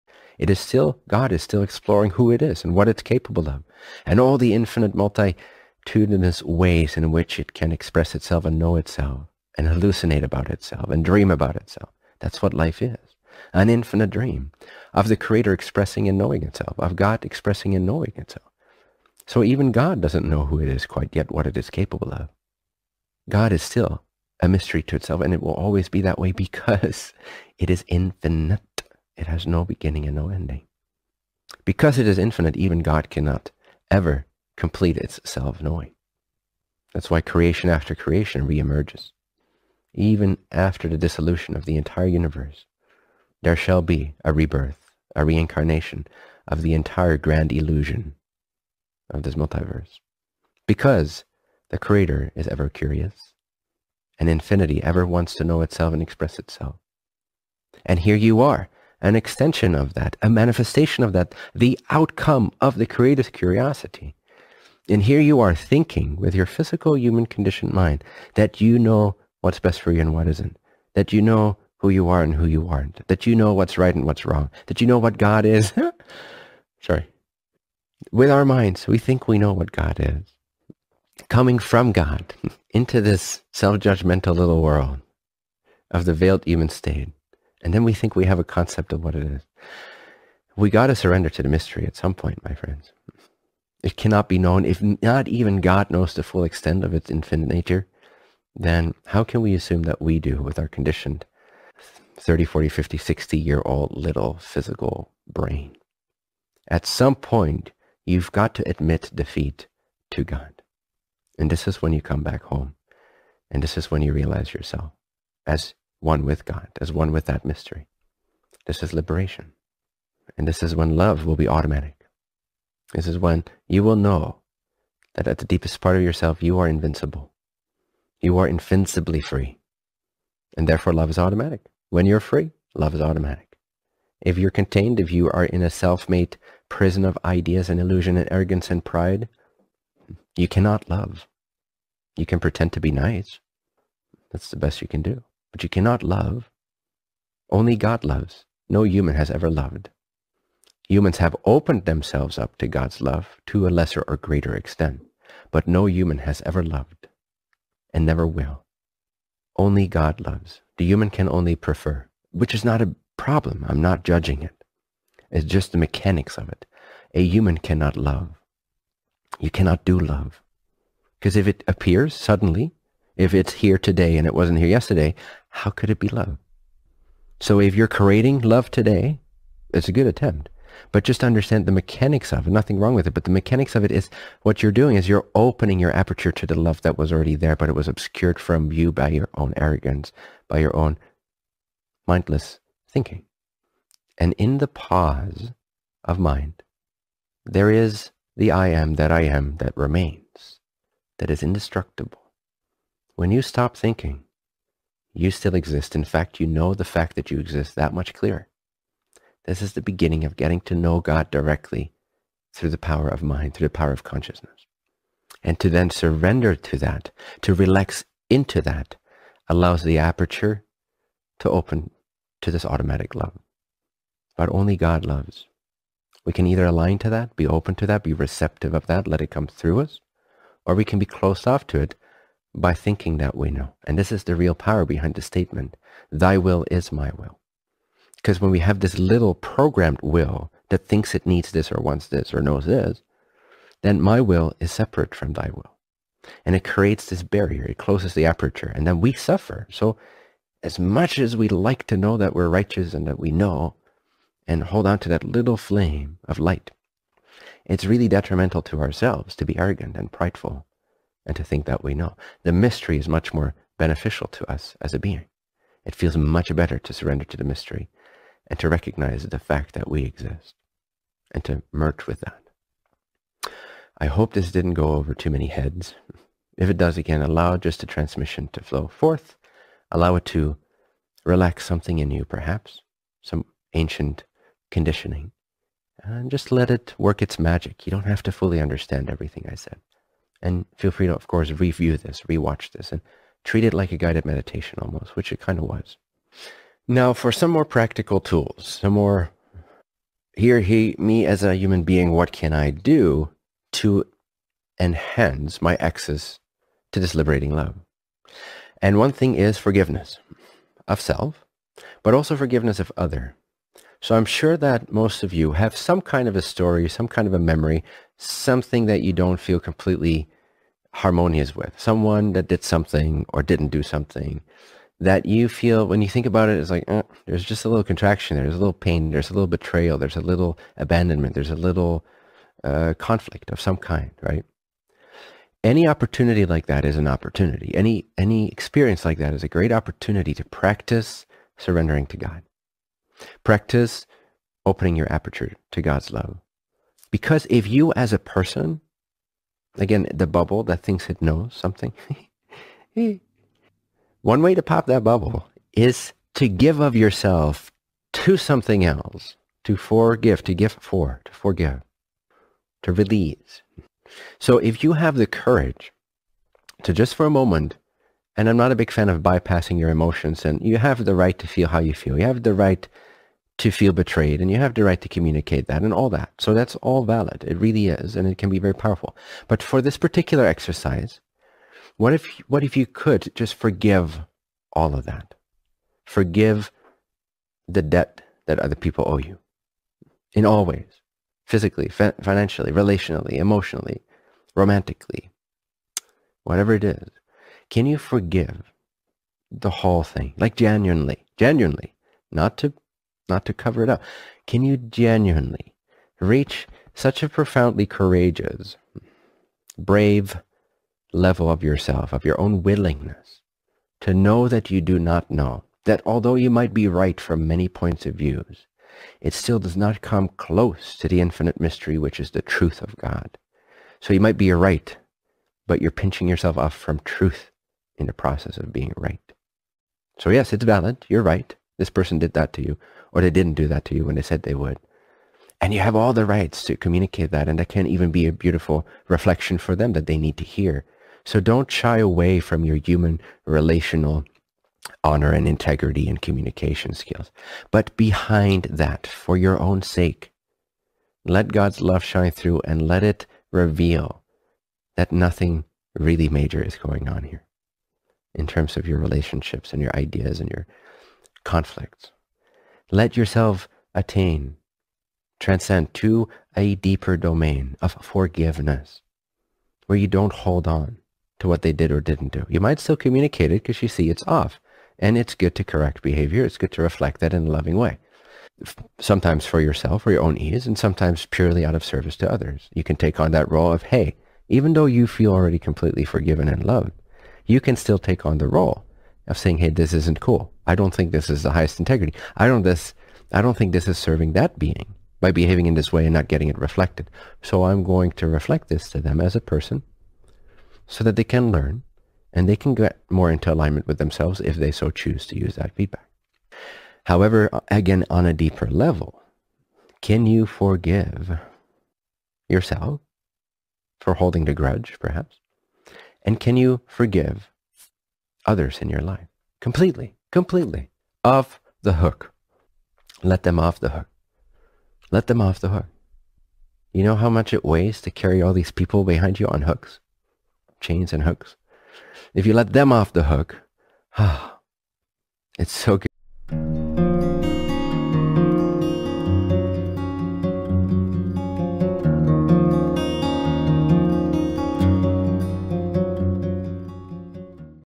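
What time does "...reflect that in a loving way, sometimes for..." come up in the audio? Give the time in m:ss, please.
7:56.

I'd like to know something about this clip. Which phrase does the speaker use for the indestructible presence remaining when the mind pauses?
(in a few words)
I am that I am.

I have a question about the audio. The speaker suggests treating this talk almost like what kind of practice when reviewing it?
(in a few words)
A guided meditation.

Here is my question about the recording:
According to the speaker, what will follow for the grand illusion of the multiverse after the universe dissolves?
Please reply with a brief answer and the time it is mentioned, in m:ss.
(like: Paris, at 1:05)
A rebirth, at 0:44.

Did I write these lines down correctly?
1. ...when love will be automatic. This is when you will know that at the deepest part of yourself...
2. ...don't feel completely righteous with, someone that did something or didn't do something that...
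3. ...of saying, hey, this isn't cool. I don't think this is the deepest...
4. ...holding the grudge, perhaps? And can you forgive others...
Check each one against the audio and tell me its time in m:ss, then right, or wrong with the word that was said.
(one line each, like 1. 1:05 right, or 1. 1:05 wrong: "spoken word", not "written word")
1. 2:00 right
2. 5:19 wrong: "harmonious", not "righteous"
3. 8:09 wrong: "highest", not "deepest"
4. 8:34 right.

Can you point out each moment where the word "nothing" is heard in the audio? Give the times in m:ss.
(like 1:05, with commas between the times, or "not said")
3:02, 7:35.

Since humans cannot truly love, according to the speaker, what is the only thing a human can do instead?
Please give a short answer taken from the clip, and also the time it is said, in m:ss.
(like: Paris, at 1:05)
Prefer, at 2:41.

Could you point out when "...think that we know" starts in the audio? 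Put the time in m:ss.
4:21.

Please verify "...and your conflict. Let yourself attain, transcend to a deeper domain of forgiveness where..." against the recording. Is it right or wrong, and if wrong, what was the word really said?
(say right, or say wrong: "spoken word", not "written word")
right.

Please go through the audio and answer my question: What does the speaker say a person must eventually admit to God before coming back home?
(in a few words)
Defeat.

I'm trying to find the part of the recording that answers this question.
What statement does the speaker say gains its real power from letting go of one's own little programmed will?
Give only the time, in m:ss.
3:56.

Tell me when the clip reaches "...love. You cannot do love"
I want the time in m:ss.
2:47.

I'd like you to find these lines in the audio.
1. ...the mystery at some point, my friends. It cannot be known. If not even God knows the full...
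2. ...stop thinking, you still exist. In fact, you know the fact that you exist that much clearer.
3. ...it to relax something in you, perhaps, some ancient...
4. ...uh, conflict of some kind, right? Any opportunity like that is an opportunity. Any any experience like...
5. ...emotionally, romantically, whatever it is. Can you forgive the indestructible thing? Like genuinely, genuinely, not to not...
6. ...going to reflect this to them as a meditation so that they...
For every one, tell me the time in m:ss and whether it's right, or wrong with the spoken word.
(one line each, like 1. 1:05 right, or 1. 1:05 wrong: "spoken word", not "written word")
1. 1:31 right
2. 3:23 right
3. 4:40 right
4. 5:32 right
5. 6:33 wrong: "whole", not "indestructible"
6. 8:17 wrong: "person", not "meditation".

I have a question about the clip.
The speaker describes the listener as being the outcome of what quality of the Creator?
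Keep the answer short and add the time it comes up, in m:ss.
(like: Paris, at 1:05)
Creative curiosity, at 1:02.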